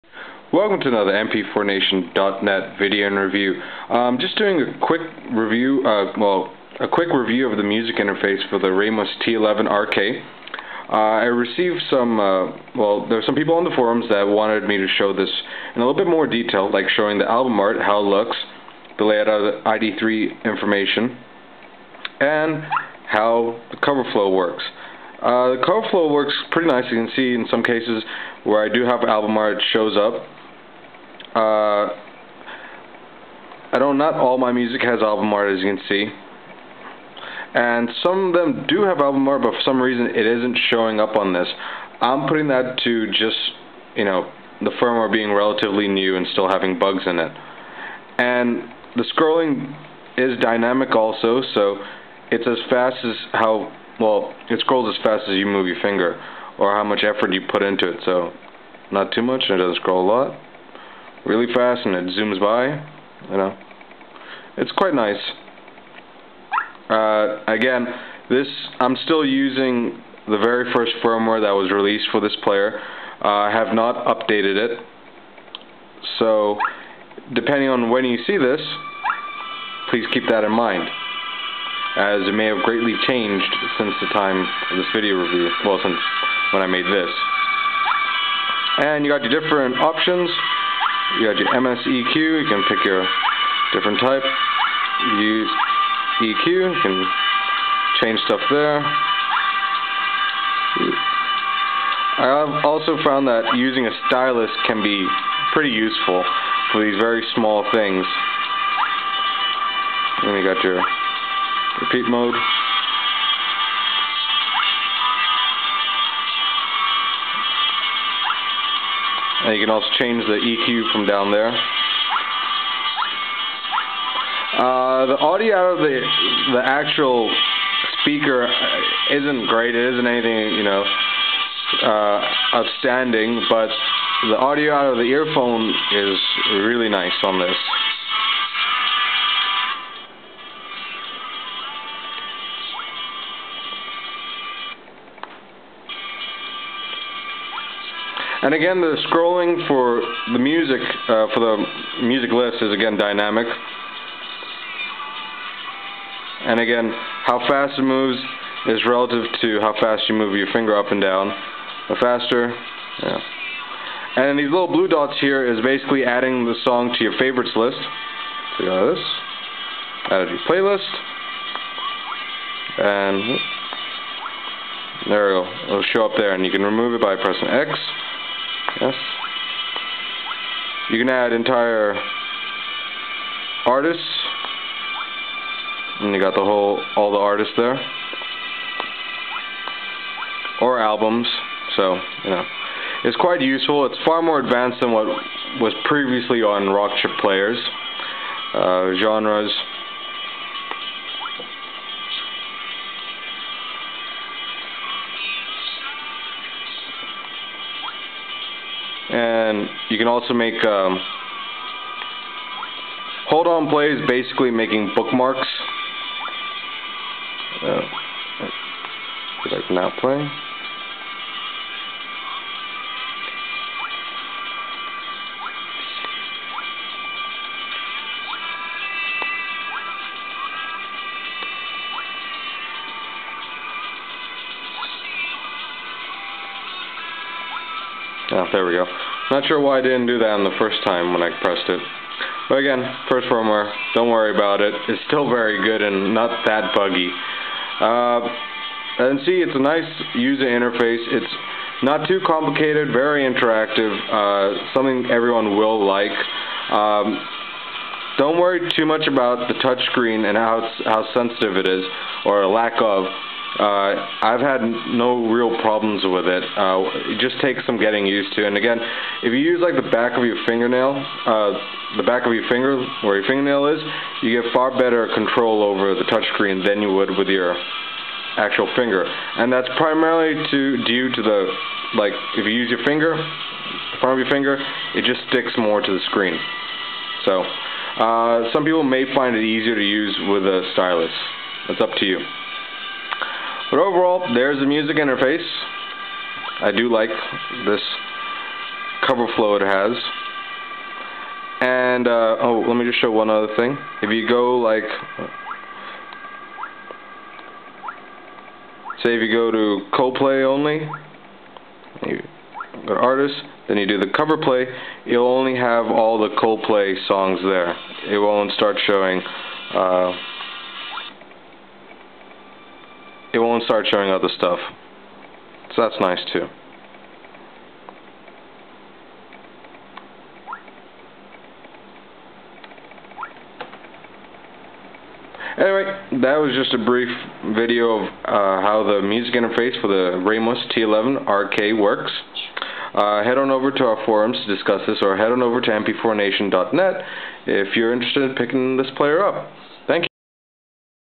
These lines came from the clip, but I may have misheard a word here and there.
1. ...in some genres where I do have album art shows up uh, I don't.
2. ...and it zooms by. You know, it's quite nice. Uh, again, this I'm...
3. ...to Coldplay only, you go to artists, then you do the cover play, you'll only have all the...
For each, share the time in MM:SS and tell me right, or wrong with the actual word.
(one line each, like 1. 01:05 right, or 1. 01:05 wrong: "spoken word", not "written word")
1. 00:27 wrong: "cases", not "genres"
2. 01:01 right
3. 05:09 right.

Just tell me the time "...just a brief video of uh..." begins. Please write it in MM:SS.
05:36.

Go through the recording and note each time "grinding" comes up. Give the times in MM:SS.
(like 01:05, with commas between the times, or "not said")
not said.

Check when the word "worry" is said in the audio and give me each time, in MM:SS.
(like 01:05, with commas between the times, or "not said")
04:04, 04:18.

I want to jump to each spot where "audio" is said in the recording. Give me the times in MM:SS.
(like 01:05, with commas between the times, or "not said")
02:05, 02:14.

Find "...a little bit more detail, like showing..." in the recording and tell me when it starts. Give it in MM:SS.
00:15.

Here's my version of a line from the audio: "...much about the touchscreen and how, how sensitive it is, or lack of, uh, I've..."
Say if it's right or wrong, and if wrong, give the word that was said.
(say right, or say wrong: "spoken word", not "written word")
right.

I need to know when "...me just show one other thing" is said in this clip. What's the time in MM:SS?
05:02.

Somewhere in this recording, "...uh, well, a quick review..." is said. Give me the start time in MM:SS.
00:05.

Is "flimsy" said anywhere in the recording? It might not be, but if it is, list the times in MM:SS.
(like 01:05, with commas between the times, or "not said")
not said.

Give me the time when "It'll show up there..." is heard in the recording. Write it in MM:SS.
02:55.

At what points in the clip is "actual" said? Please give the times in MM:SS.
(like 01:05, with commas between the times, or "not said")
02:06, 04:38.